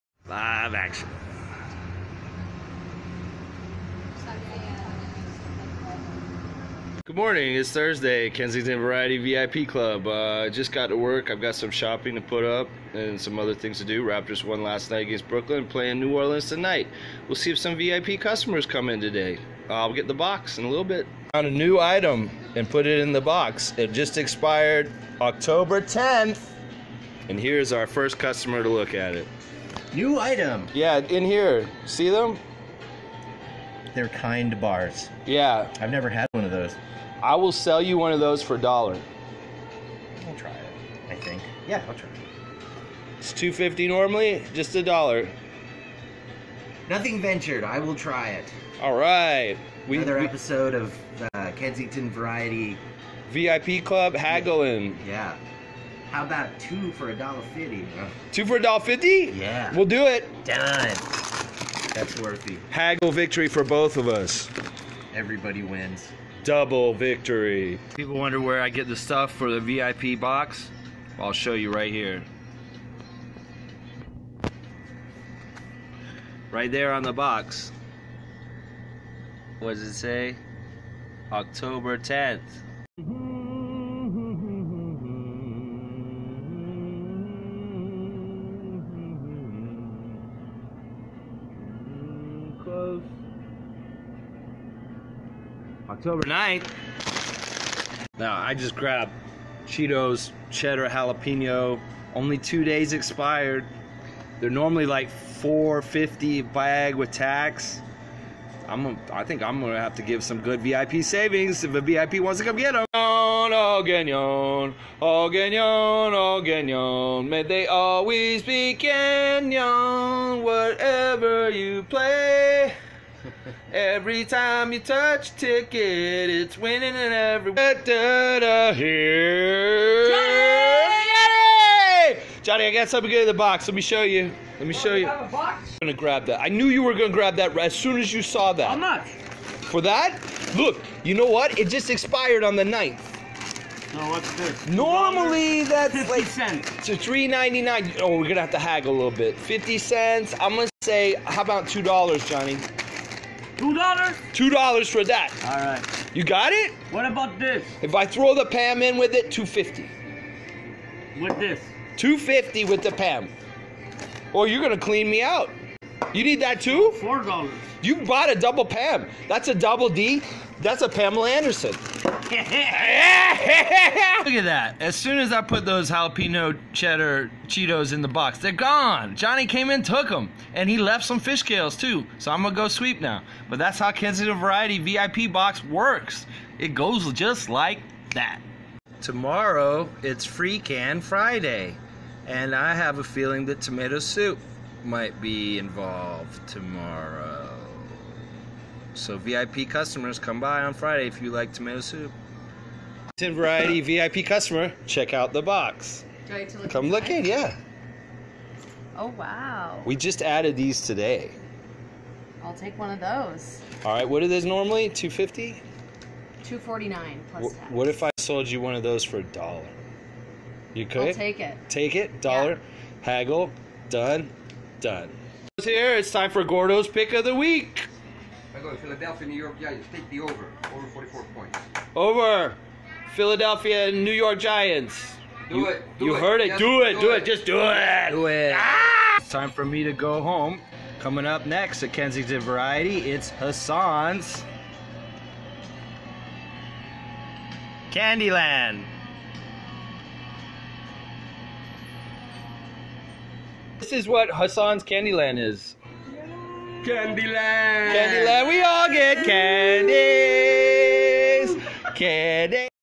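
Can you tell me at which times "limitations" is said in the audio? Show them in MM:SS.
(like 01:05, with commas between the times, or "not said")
not said.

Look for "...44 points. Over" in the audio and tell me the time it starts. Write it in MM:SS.
03:50.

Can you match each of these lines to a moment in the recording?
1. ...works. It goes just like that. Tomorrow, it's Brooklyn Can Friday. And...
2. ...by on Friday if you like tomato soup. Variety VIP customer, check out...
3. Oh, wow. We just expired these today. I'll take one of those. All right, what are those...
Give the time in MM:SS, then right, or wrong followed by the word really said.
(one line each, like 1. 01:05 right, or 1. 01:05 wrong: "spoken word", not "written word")
1. 03:05 wrong: "Free", not "Brooklyn"
2. 03:20 right
3. 03:28 wrong: "added", not "expired".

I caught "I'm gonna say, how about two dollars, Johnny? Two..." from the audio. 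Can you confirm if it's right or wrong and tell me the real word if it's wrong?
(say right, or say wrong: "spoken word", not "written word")
right.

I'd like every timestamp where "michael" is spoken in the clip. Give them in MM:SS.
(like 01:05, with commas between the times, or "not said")
not said.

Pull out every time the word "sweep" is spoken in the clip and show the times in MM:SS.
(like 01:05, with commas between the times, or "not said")
03:02.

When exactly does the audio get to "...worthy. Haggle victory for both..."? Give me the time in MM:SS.
01:02.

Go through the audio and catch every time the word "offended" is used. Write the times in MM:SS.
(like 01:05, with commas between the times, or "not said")
not said.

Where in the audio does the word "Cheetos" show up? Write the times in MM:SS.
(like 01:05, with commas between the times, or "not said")
01:39, 02:57.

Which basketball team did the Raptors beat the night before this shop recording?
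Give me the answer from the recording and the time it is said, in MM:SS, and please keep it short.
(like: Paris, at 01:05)
Brooklyn, at 00:15.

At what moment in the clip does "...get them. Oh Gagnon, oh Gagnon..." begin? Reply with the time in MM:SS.
01:52.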